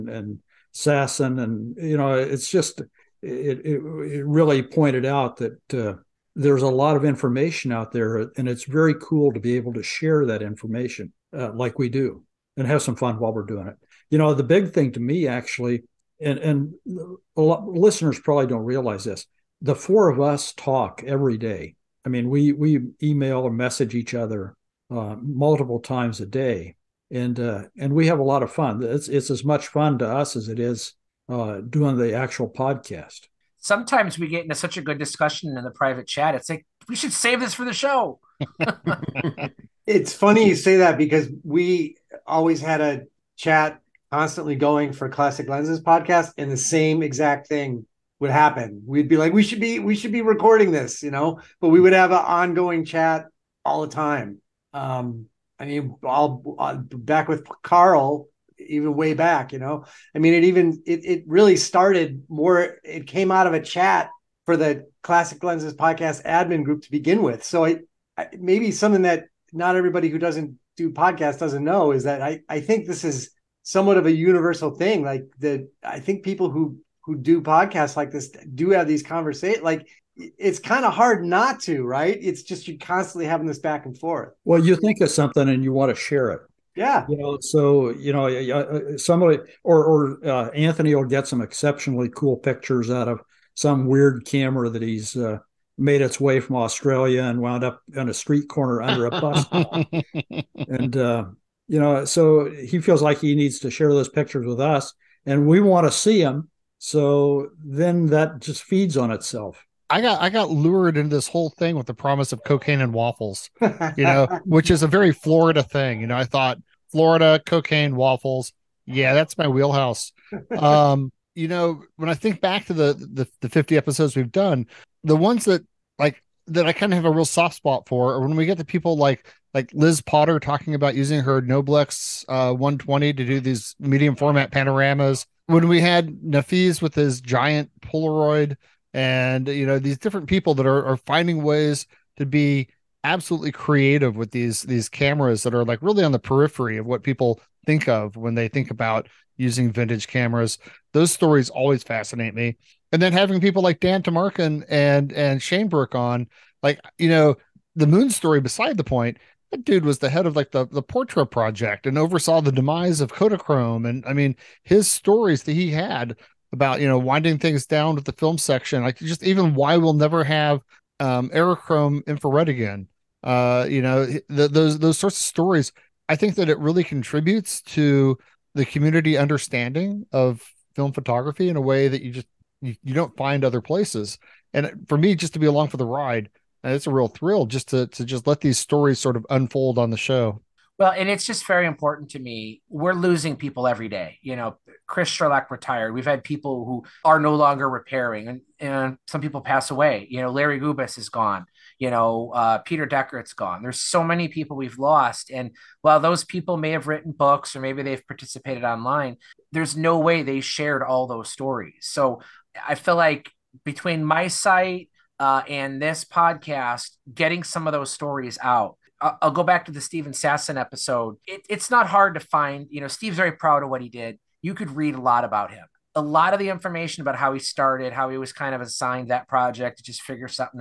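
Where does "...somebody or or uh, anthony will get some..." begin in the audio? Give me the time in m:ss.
1:28.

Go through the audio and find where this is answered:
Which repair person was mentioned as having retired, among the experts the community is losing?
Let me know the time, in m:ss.
3:14.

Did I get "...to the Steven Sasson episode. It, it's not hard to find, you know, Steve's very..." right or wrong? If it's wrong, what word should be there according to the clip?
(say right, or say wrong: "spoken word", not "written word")
right.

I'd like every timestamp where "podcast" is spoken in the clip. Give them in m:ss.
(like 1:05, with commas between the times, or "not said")
0:32, 0:45, 1:05, 1:10, 1:17, 3:36.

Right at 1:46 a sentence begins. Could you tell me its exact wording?
So then that just feeds on itself.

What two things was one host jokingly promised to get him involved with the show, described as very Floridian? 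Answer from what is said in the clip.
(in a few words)
cocaine and waffles.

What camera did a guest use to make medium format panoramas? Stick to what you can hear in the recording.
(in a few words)
Noblex 120.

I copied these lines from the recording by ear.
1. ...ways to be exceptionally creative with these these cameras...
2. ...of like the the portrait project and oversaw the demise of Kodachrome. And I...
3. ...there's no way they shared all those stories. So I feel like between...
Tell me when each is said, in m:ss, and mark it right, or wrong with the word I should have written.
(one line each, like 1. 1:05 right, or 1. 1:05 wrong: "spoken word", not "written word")
1. 2:21 wrong: "absolutely", not "exceptionally"
2. 2:40 right
3. 3:29 right.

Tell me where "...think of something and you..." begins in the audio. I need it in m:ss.
1:24.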